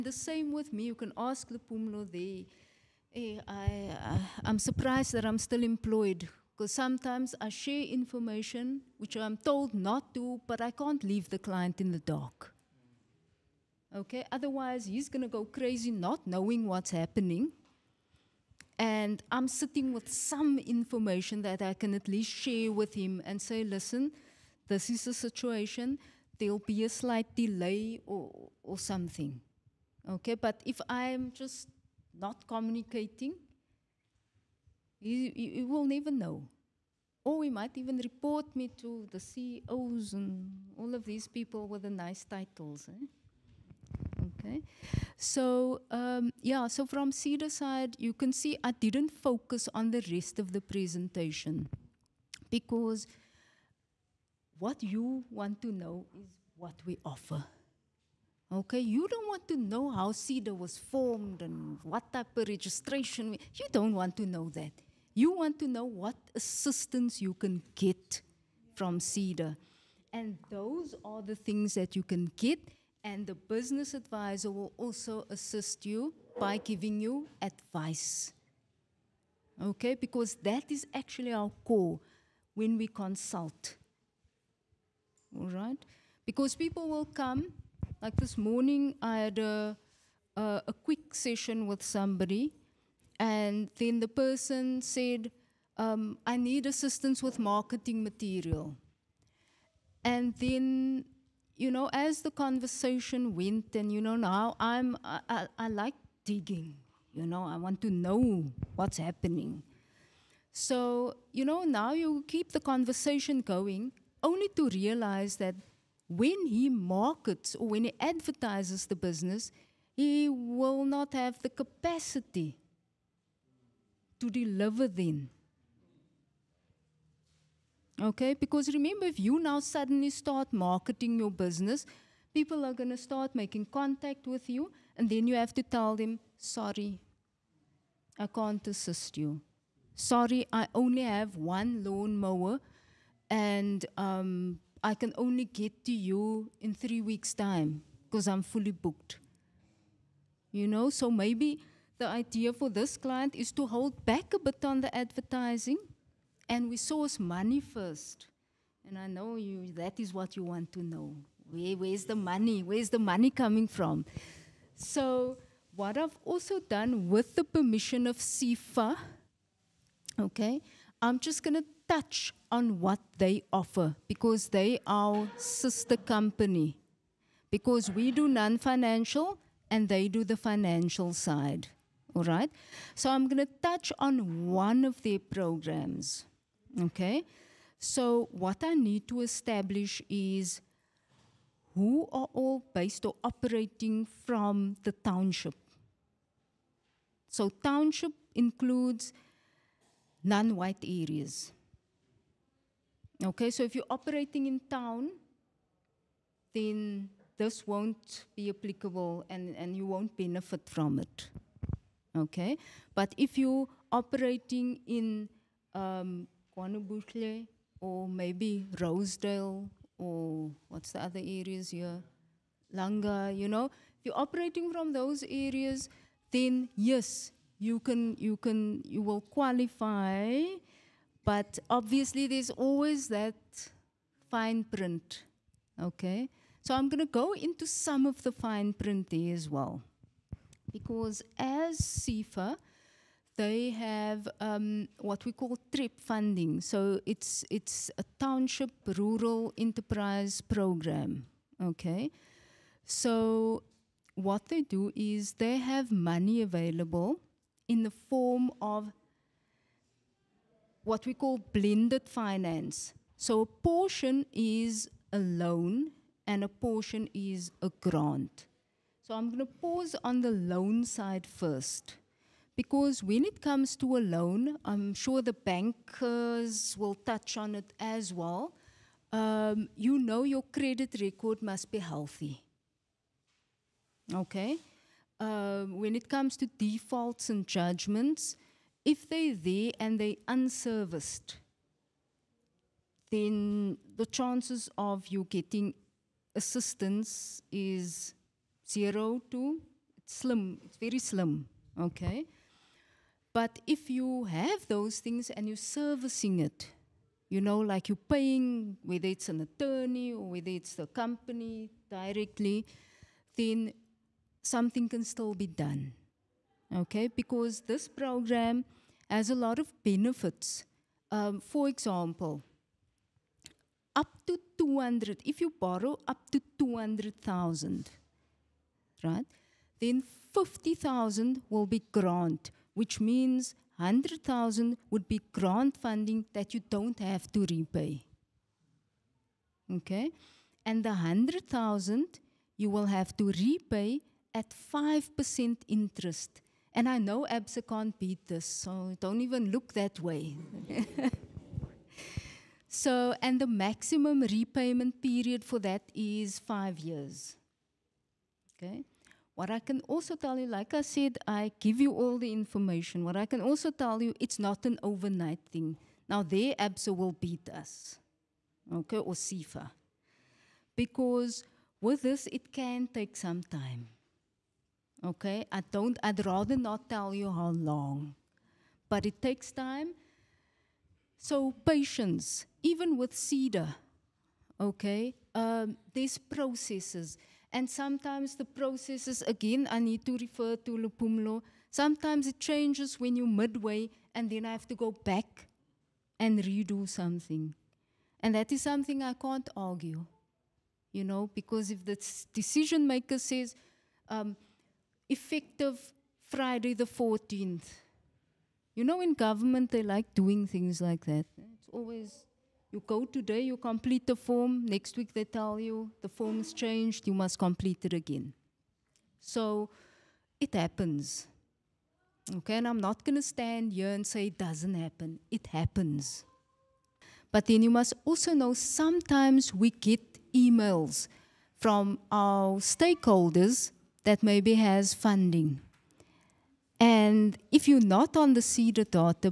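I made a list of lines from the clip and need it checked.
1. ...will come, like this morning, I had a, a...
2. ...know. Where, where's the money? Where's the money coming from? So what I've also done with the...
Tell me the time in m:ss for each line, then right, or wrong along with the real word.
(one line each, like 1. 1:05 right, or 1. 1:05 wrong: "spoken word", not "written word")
1. 1:26 right
2. 2:40 right.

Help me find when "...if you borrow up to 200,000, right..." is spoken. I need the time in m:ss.
5:25.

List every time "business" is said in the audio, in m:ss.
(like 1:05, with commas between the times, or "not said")
1:13, 1:58, 2:11.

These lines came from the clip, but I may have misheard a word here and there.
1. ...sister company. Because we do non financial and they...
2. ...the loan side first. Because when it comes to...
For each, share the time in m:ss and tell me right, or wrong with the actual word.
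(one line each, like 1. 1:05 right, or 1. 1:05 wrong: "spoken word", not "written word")
1. 2:55 right
2. 4:30 right.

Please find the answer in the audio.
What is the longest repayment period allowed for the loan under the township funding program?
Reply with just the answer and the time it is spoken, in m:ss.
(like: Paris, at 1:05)
Five years, at 5:56.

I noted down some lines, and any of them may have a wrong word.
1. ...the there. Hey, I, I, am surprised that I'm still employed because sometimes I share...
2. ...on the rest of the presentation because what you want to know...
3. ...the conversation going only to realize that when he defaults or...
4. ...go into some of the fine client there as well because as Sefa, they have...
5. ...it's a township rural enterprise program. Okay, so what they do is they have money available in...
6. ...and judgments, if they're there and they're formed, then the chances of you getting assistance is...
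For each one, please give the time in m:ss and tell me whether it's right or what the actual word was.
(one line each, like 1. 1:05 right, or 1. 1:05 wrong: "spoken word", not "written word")
1. 0:01 right
2. 0:49 right
3. 1:52 wrong: "markets", not "defaults"
4. 3:57 wrong: "print", not "client"
5. 4:07 right
6. 4:47 wrong: "unserviced", not "formed".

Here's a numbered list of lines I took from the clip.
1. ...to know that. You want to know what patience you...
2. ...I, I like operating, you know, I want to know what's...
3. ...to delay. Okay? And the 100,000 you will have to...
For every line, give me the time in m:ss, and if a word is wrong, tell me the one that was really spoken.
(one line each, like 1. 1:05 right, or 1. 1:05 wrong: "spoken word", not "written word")
1. 1:04 wrong: "assistance", not "patience"
2. 1:45 wrong: "digging", not "operating"
3. 5:37 wrong: "repay", not "delay".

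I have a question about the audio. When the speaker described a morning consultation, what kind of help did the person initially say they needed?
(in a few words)
Marketing material.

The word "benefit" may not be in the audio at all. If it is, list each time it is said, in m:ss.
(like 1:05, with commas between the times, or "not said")
3:30, 5:19.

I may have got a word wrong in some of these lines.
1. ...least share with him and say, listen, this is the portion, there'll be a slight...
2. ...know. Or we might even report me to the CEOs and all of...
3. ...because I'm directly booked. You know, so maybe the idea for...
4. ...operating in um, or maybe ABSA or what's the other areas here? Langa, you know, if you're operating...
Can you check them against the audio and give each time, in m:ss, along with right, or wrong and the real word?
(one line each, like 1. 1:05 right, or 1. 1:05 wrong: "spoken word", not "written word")
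1. 0:22 wrong: "situation", not "portion"
2. 0:36 right
3. 2:28 wrong: "fully", not "directly"
4. 3:33 wrong: "Rosedale", not "ABSA".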